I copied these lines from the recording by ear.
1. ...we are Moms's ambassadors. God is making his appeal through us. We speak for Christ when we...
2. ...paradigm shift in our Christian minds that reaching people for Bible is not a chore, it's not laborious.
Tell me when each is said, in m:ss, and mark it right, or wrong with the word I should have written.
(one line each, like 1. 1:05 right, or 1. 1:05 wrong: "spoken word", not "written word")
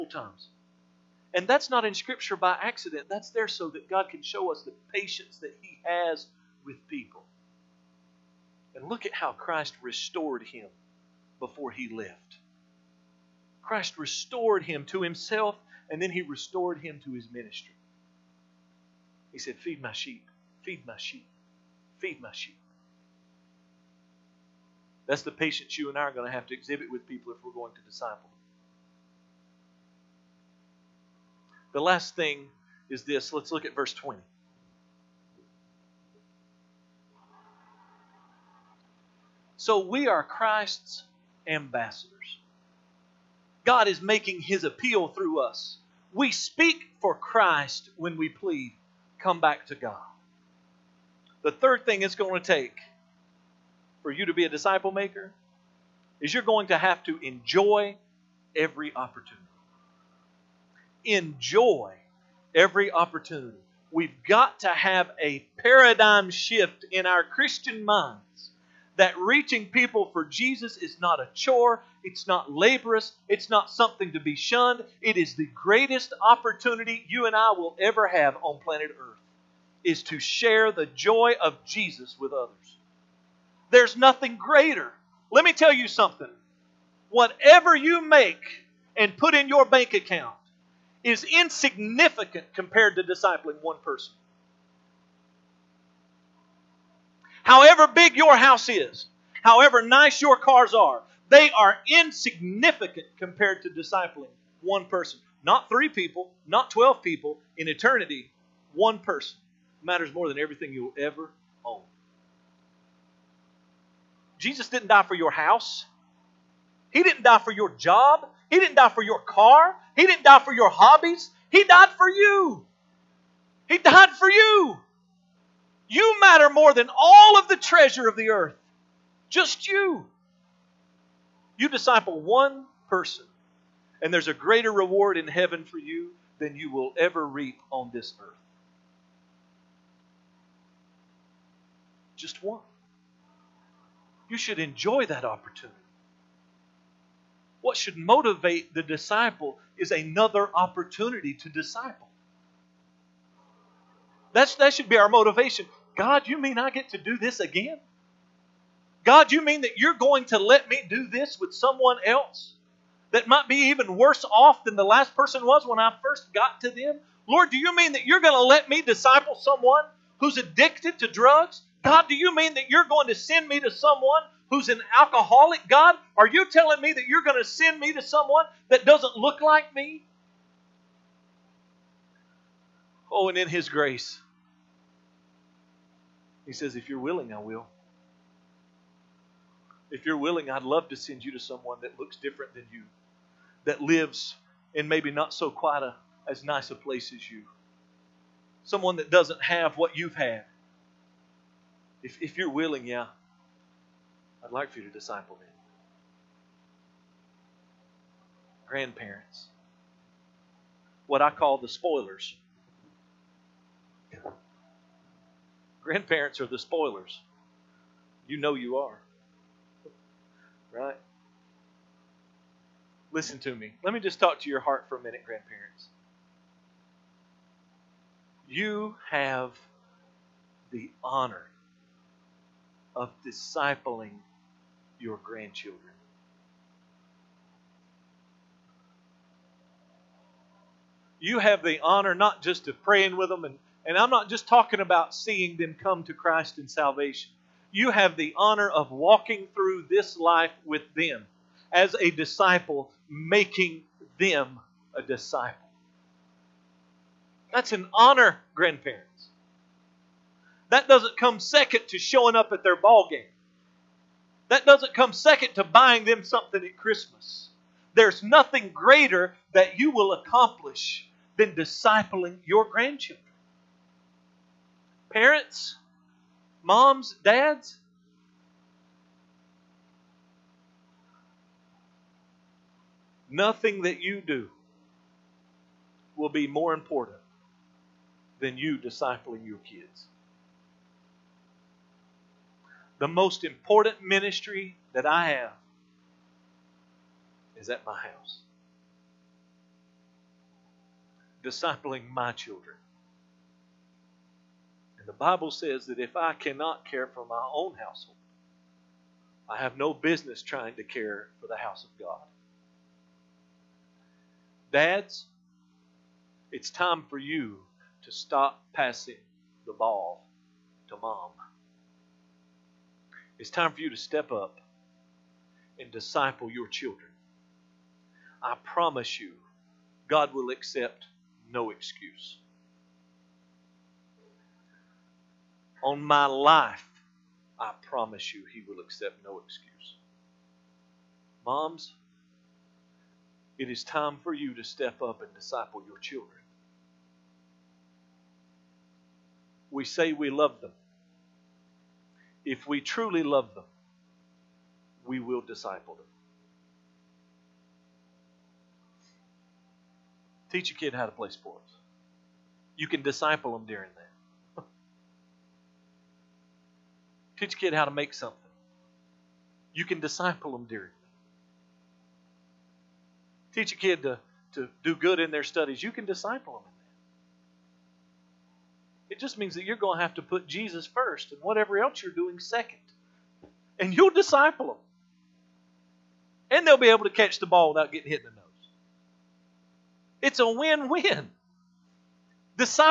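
1. 0:39 wrong: "Christ", not "Moms"
2. 1:05 wrong: "Jesus", not "Bible".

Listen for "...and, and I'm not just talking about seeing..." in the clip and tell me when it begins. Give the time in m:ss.
4:03.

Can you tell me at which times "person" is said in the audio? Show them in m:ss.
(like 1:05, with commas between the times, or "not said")
1:33, 1:44, 1:48, 2:12, 2:45.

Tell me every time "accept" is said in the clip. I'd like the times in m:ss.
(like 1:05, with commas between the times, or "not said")
5:30, 5:38.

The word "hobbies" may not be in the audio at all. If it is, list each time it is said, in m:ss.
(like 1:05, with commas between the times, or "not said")
2:00.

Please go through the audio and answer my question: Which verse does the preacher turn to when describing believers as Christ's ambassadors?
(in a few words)
Verse 20.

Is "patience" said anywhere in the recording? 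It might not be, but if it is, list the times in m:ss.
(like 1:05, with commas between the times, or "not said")
0:04, 0:25.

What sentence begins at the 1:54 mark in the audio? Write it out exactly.
Jesus didn't die for your house.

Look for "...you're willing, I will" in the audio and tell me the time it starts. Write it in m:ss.
3:06.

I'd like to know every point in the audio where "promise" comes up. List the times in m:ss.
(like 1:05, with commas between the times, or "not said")
5:28, 5:37.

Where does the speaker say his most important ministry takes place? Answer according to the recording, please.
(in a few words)
At my house.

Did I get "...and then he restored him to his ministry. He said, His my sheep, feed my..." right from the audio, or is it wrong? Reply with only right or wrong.
wrong.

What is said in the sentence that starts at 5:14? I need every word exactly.
Dads, it's time for you to stop passing the ball to mom.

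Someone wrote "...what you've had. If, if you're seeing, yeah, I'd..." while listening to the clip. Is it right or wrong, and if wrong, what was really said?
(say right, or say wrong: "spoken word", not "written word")
wrong: "willing", not "seeing".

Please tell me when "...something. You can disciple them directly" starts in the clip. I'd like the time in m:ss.
6:08.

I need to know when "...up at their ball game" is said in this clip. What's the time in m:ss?
4:22.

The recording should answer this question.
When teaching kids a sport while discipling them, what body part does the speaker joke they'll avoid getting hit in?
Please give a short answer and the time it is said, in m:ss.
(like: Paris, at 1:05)
The nose, at 6:28.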